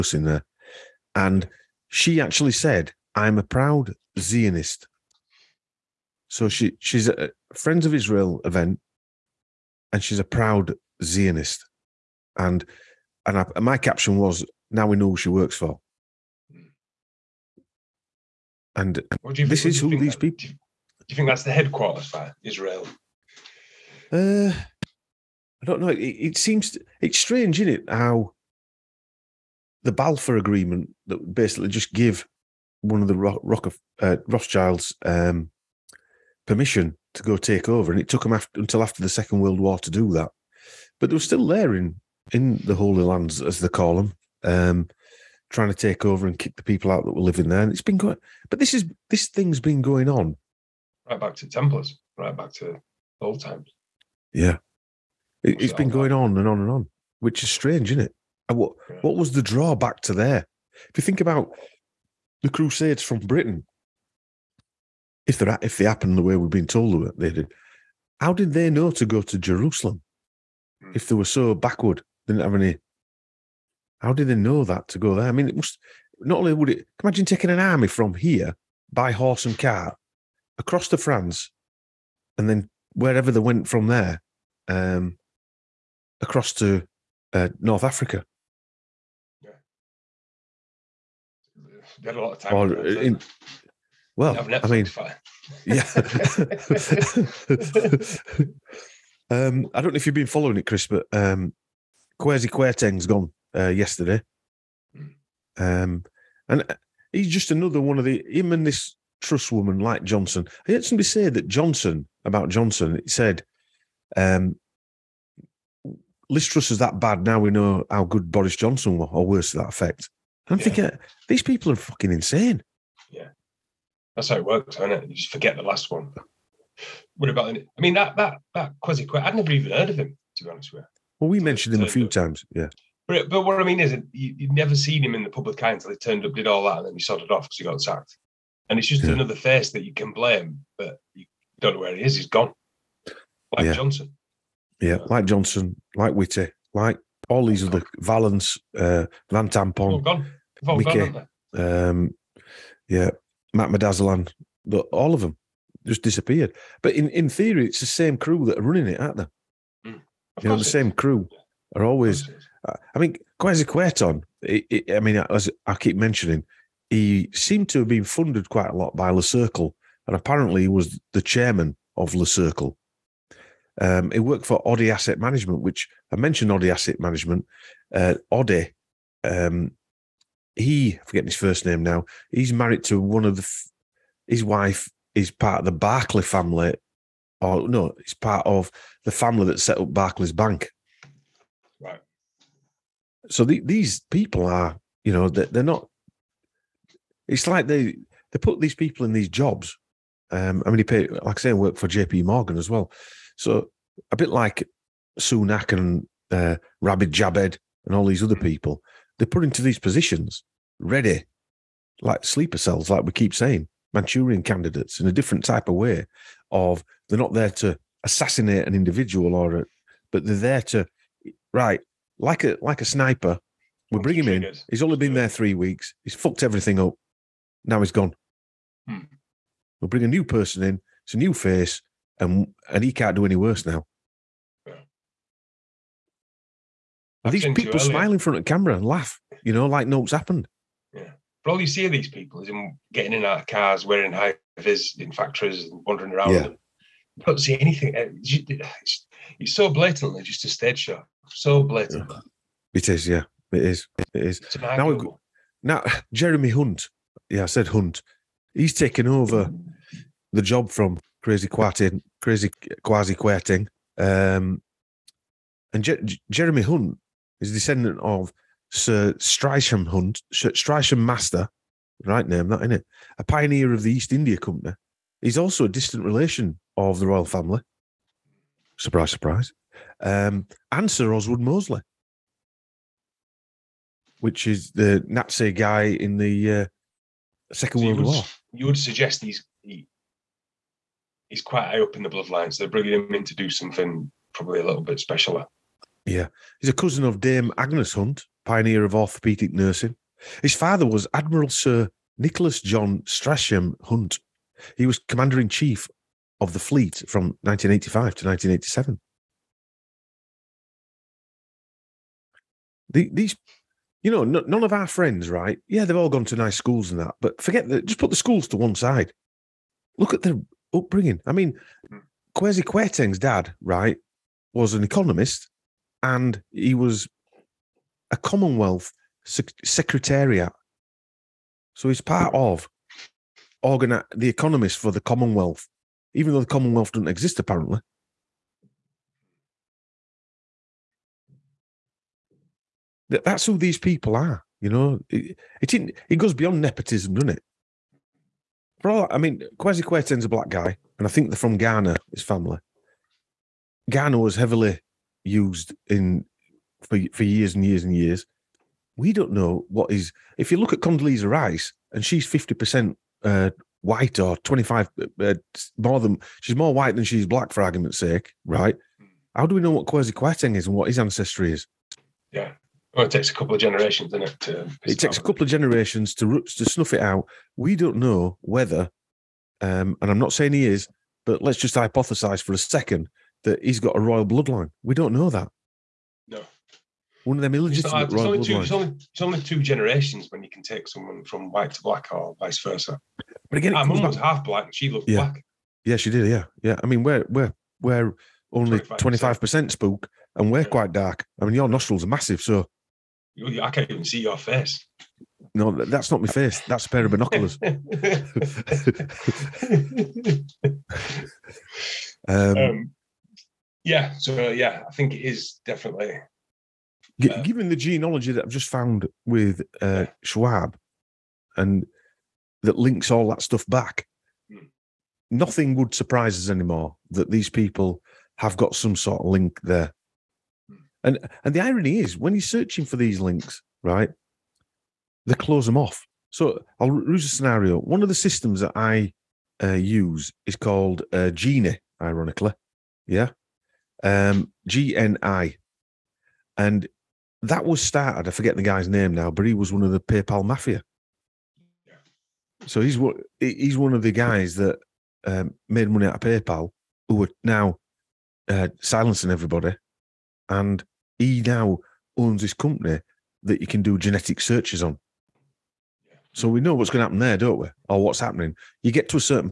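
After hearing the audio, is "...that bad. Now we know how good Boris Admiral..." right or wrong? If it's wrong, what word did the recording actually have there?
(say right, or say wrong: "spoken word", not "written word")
wrong: "Johnson", not "Admiral".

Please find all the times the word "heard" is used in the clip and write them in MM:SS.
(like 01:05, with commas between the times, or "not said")
01:50, 02:09.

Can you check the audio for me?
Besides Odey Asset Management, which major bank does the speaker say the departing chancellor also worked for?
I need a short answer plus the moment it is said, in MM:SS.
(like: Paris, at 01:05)
J.P. Morgan, at 03:21.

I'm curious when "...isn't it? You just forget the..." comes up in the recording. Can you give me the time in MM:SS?
02:04.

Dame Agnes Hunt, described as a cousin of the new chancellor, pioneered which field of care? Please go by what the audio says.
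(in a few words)
Orthopedic nursing.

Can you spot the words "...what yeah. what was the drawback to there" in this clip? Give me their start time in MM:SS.
00:58.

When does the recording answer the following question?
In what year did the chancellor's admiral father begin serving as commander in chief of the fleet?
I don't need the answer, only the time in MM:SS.
05:07.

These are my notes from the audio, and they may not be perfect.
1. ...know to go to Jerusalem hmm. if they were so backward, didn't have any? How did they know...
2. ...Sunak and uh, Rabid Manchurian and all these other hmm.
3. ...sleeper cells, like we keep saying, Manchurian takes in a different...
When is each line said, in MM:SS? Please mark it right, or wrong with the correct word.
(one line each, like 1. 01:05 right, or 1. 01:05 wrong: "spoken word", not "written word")
1. 01:08 right
2. 03:25 wrong: "Jabed", not "Manchurian"
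3. 03:32 wrong: "candidates", not "takes".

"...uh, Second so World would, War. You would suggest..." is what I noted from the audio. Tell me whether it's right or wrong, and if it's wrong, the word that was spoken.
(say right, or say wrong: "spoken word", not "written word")
right.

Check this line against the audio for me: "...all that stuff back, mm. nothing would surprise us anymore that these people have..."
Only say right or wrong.
right.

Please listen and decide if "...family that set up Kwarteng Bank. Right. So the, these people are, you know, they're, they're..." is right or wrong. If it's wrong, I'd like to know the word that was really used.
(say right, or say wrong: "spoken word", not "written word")
wrong: "Barclays", not "Kwarteng".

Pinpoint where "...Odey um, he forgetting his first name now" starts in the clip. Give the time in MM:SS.
02:58.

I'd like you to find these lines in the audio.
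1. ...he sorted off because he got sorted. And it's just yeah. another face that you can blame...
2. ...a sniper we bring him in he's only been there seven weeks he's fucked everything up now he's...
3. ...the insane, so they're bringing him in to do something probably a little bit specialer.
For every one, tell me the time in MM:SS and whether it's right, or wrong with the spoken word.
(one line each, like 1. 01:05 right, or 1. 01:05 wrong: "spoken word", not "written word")
1. 02:16 wrong: "sacked", not "sorted"
2. 03:42 wrong: "three", not "seven"
3. 04:52 wrong: "bloodline", not "insane".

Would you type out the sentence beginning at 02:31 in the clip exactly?
Um, yeah, Matt Medazalan, all of them just disappeared.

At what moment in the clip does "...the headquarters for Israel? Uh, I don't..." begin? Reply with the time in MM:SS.
00:21.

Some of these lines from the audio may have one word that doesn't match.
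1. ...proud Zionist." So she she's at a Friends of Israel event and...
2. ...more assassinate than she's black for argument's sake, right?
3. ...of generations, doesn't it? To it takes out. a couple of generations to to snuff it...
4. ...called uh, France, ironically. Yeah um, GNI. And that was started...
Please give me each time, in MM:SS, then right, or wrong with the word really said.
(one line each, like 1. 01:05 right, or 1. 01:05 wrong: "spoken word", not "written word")
1. 00:03 right
2. 06:06 wrong: "white", not "assassinate"
3. 06:13 right
4. 07:20 wrong: "Geni", not "France".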